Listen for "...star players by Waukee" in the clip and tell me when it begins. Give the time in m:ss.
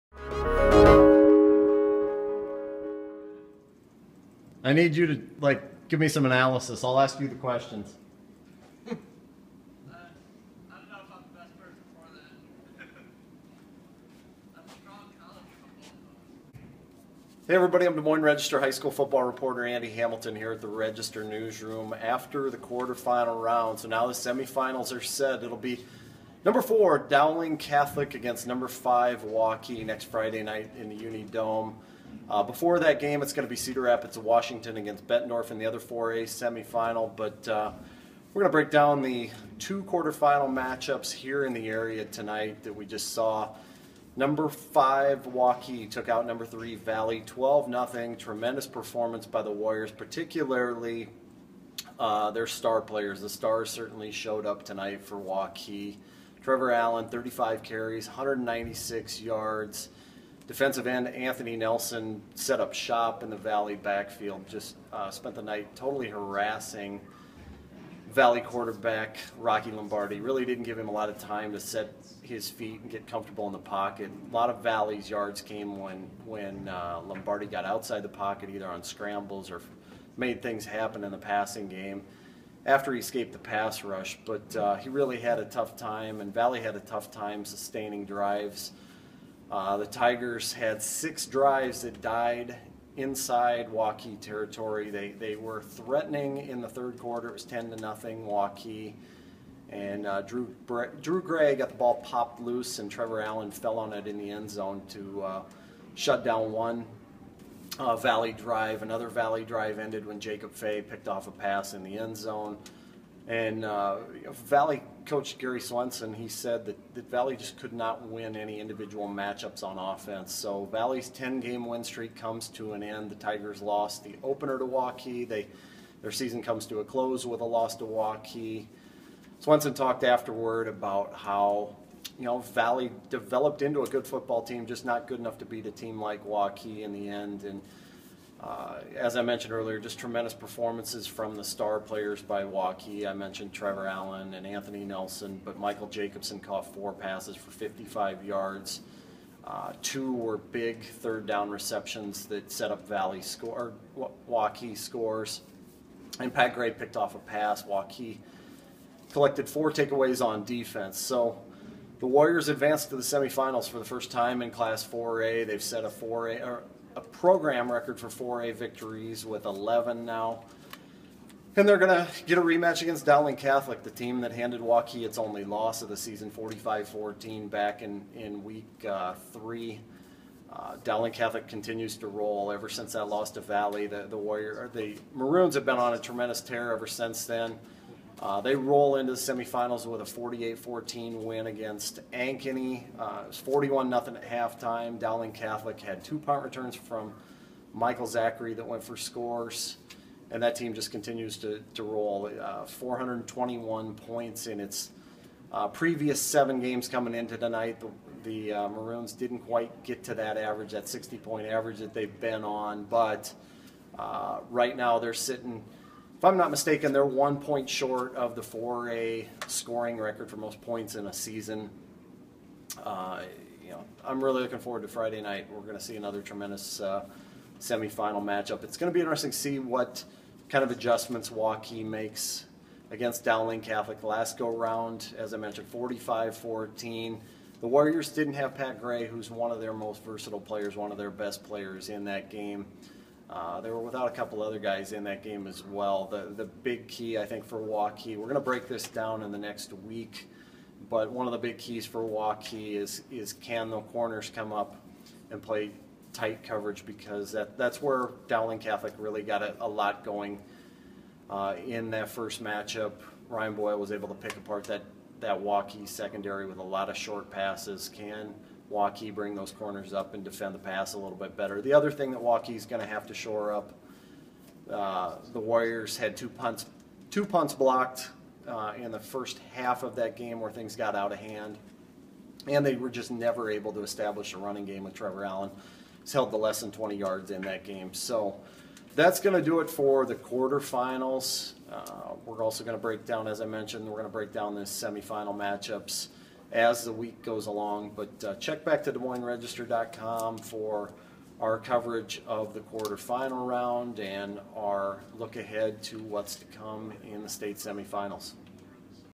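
2:21.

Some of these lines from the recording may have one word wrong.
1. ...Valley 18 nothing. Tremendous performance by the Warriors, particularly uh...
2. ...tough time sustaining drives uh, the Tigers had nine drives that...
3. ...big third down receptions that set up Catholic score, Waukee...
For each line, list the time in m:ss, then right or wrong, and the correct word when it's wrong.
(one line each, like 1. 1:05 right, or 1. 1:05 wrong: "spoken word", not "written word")
1. 0:46 wrong: "12", not "18"
2. 1:26 wrong: "six", not "nine"
3. 2:30 wrong: "Valley", not "Catholic".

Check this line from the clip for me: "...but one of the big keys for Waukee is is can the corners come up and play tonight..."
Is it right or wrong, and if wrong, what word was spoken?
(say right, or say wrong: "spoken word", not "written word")
wrong: "tight", not "tonight".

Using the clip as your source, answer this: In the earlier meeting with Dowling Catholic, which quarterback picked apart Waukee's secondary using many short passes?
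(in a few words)
Ryan Boyle.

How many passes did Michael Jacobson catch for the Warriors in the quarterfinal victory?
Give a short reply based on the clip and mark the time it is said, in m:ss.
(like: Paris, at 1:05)
4, at 2:26.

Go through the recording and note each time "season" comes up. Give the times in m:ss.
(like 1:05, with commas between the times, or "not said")
2:06, 2:55, 3:41.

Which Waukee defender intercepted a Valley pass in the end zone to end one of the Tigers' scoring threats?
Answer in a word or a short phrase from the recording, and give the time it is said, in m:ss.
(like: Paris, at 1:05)
Jacob Fay, at 1:50.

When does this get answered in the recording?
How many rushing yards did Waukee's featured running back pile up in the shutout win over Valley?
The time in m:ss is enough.
0:58.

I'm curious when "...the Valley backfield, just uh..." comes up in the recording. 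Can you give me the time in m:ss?
1:03.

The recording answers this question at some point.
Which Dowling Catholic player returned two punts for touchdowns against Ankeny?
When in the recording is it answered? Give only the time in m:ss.
3:17.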